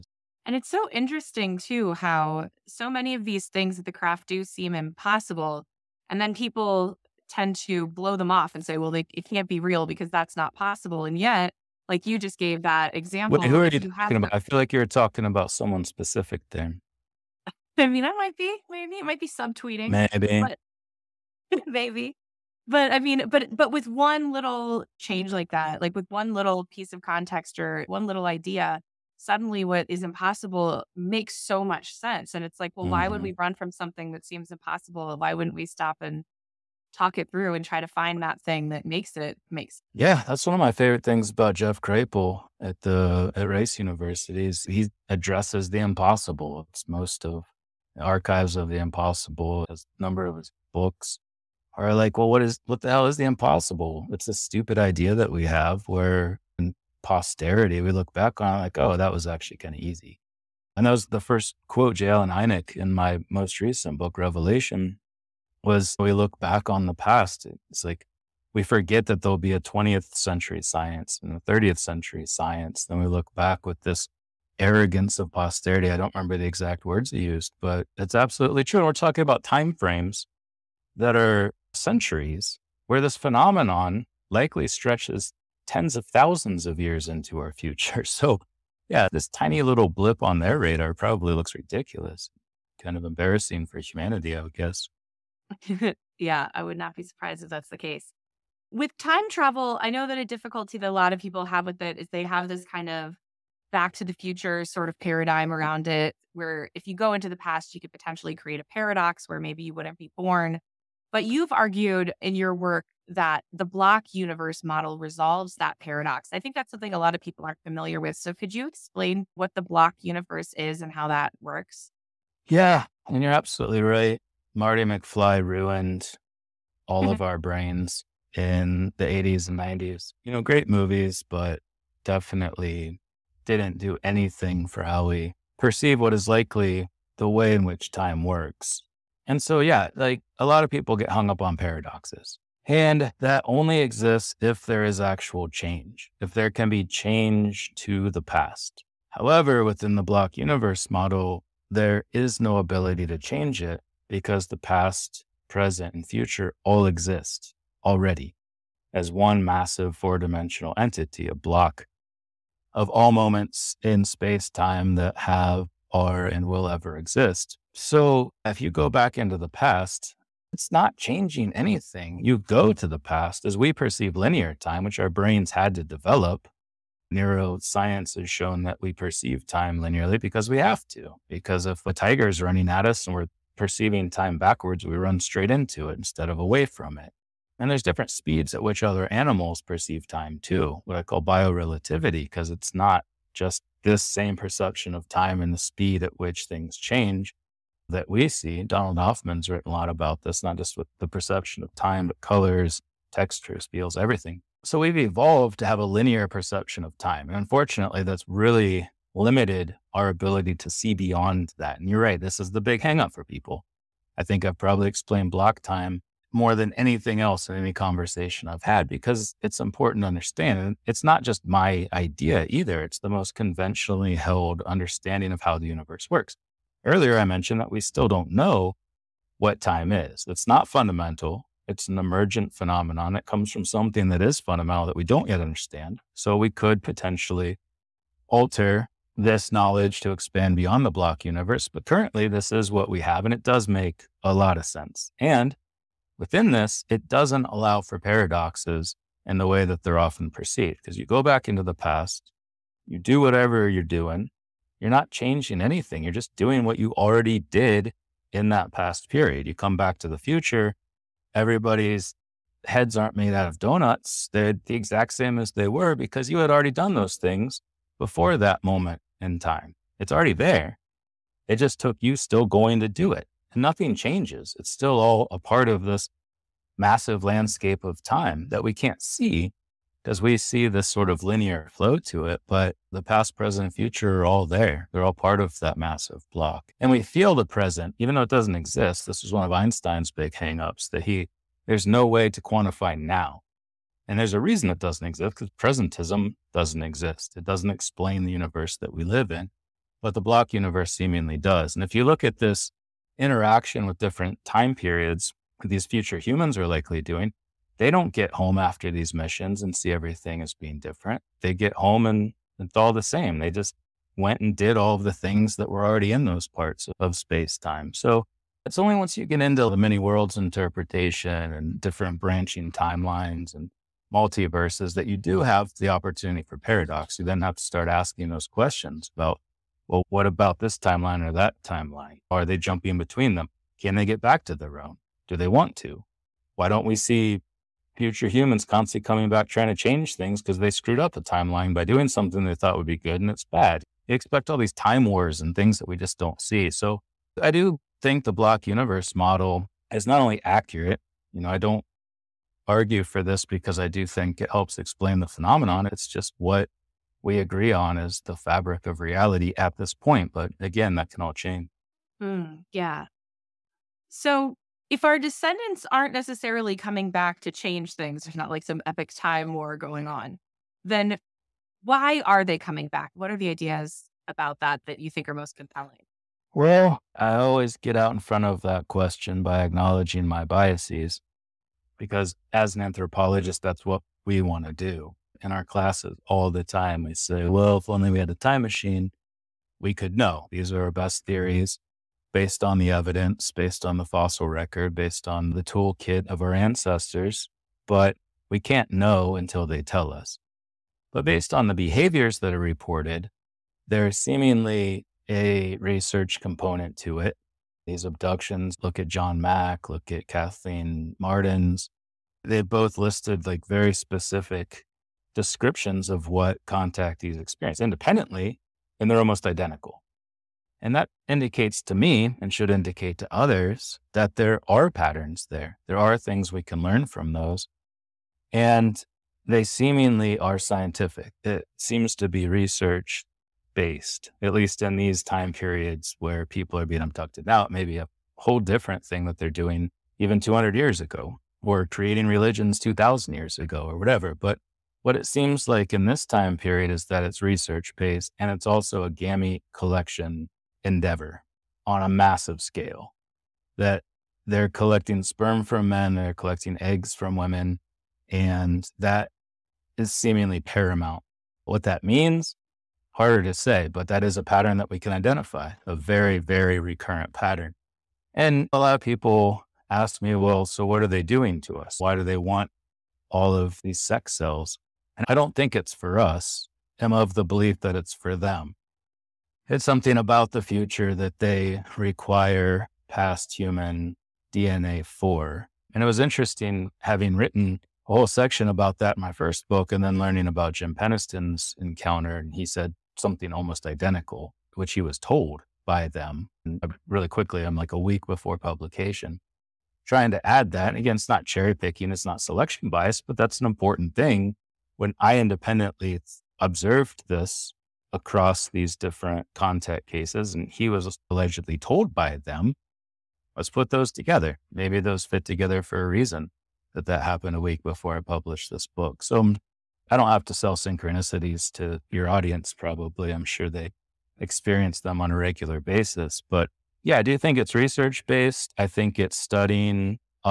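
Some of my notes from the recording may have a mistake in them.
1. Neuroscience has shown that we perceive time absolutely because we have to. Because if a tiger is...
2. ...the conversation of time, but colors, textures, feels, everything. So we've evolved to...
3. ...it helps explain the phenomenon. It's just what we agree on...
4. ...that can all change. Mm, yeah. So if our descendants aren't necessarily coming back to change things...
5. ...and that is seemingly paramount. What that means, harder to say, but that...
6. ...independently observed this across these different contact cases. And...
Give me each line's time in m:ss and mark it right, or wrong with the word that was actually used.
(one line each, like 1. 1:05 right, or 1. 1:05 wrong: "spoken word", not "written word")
1. 2:57 wrong: "linearly", not "absolutely"
2. 3:20 wrong: "perception", not "conversation"
3. 5:54 right
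4. 6:00 right
5. 7:38 right
6. 8:25 right.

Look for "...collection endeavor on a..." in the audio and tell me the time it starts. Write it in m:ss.
7:29.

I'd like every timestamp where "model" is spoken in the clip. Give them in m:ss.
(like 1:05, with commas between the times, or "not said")
1:54, 2:30, 5:49.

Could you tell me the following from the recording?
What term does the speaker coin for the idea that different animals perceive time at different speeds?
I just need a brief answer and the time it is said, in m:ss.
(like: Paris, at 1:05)
biorelativity, at 3:11.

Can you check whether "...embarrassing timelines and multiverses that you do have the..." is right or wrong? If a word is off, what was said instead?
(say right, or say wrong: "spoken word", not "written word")
wrong: "branching", not "embarrassing".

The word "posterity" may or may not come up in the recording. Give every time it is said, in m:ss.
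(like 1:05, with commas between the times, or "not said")
0:57, 1:15.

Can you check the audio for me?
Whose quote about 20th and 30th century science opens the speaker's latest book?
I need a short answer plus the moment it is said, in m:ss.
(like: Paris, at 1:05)
J. Allen Hynek, at 1:01.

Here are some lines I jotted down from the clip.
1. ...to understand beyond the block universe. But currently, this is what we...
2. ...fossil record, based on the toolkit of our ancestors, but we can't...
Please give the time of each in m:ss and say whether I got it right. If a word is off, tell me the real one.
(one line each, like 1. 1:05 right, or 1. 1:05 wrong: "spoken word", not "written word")
1. 3:59 wrong: "expand", not "understand"
2. 6:34 right.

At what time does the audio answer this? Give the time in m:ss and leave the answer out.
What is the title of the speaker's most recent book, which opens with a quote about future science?
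1:04.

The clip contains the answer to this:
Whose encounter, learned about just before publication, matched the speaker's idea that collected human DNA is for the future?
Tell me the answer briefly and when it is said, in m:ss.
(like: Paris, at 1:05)
Jim Penniston, at 8:10.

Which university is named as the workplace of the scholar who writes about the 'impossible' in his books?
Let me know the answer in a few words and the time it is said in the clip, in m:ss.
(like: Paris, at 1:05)
Rice University, at 0:43.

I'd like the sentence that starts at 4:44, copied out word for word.
They're all part of that massive block.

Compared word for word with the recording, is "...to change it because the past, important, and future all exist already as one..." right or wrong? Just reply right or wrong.
wrong.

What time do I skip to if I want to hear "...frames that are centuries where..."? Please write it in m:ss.
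1:19.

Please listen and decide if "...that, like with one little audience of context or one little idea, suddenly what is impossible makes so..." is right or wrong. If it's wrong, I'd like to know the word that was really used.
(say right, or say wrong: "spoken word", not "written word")
wrong: "piece", not "audience".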